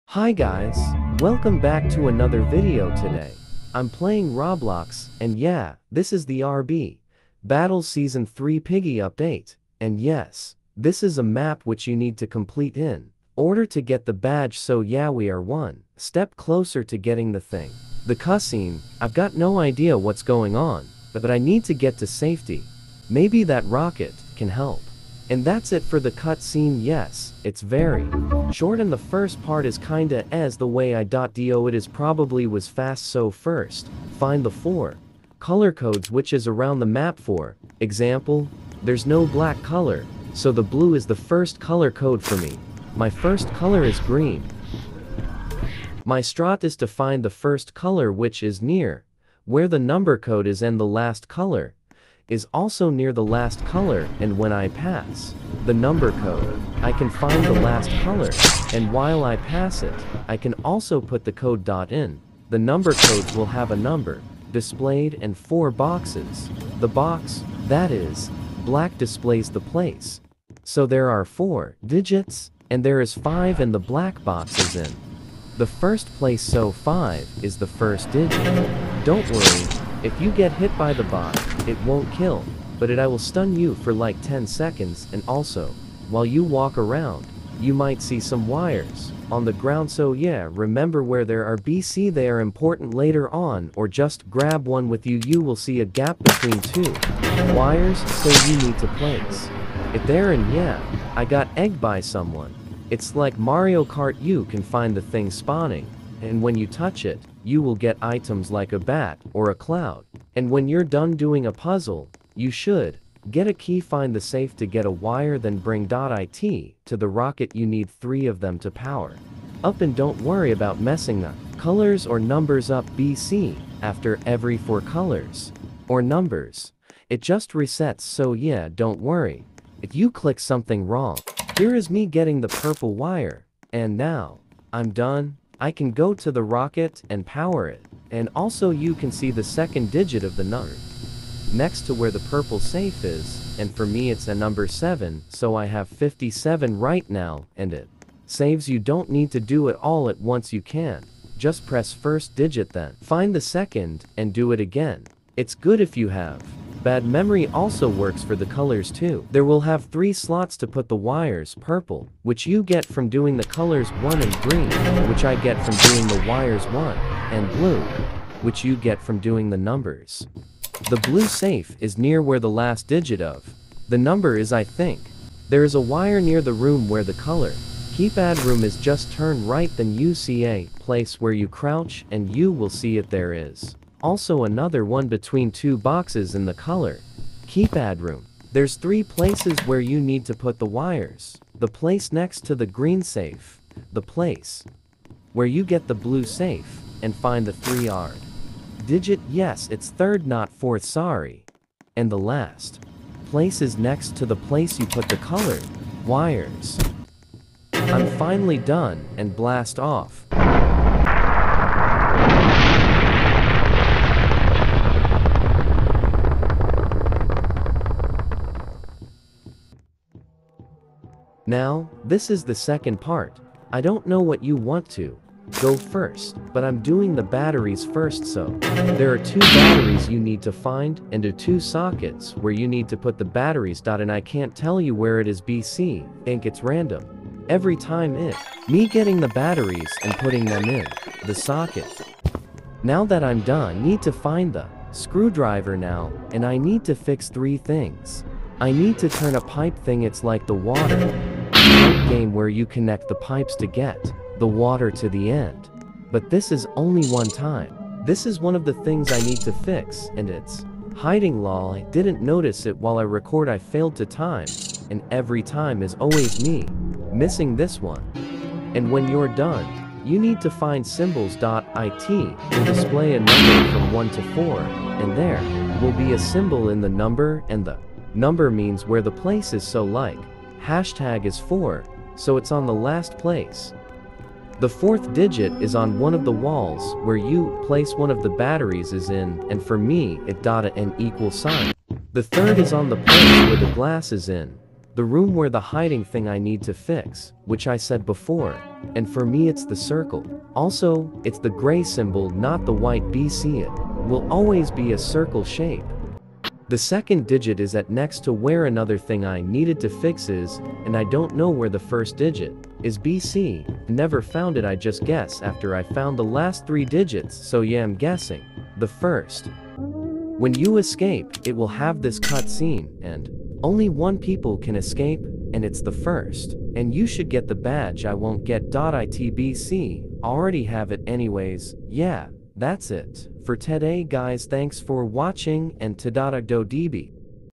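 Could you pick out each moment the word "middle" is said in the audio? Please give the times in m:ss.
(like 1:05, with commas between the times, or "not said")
not said.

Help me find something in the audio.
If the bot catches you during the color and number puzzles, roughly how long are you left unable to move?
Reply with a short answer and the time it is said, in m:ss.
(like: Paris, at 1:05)
10 seconds, at 1:24.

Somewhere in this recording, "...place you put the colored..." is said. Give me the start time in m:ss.
3:24.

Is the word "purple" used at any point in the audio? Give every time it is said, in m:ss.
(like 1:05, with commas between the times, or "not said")
2:12, 2:22, 2:41.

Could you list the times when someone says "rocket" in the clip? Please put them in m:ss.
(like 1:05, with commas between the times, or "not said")
0:23, 1:57, 2:16.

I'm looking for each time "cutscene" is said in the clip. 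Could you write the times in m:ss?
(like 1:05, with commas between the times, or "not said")
0:26, 5:22.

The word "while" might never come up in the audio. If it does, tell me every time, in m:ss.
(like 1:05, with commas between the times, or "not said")
0:58, 1:26, 4:22.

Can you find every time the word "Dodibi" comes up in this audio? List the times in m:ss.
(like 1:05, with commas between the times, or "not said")
5:36.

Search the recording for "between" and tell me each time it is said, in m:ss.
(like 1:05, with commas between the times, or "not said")
1:36, 3:05.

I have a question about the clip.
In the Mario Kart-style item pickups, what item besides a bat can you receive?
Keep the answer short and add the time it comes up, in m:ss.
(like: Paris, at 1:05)
a cloud, at 1:49.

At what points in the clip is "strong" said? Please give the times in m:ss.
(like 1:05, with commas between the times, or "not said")
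not said.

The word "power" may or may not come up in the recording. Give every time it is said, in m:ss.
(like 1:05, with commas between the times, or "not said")
1:58, 2:17.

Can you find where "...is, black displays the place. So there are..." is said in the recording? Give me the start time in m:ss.
1:07.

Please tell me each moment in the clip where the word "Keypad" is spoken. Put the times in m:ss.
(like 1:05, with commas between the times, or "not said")
2:57, 3:07.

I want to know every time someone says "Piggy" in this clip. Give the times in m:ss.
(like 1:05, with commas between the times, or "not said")
0:08.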